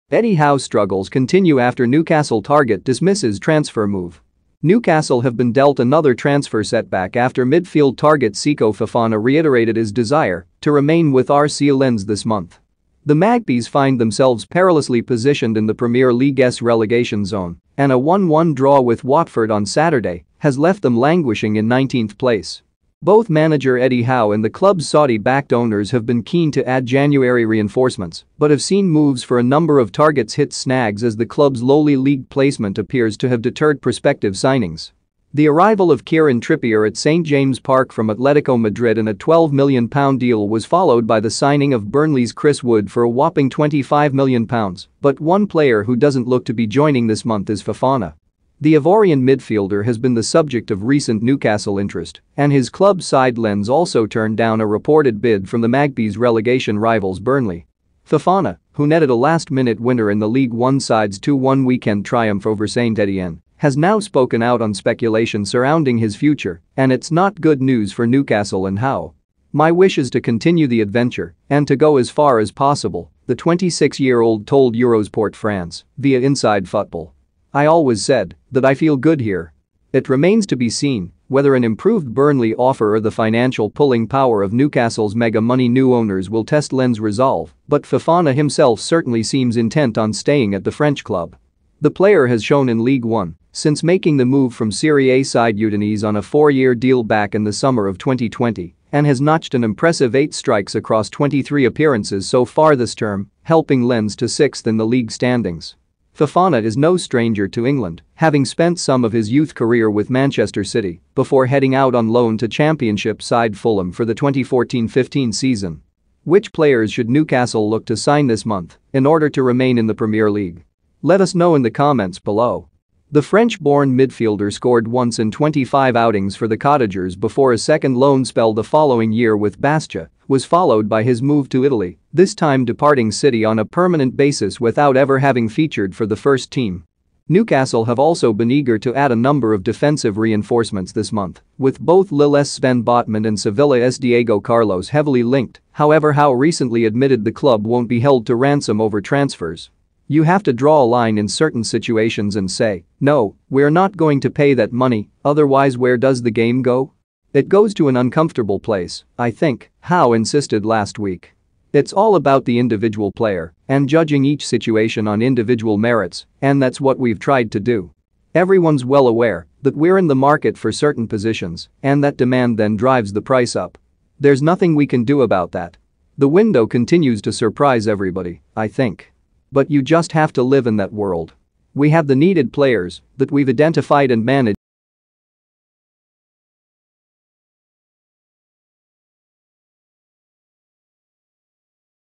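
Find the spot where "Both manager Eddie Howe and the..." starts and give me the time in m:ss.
0:23.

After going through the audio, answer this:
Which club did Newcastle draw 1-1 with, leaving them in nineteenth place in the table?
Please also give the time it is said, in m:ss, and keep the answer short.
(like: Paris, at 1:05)
Watford, at 0:19.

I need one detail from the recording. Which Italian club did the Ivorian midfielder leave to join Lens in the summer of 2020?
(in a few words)
Udinese.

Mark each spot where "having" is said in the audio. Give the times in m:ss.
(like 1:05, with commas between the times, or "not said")
1:48, 2:15.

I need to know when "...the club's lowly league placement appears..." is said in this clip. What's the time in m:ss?
0:31.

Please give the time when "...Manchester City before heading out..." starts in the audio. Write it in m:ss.
1:50.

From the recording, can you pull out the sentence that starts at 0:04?
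Newcastle have been dealt another transfer setback after midfield target Seko Fofana reiterated his desire to remain with RC Lens this month.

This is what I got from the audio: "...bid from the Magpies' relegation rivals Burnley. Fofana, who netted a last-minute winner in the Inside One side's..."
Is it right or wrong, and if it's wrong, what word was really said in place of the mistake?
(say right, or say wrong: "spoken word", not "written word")
wrong: "League", not "Inside".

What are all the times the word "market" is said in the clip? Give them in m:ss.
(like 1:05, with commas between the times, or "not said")
2:50.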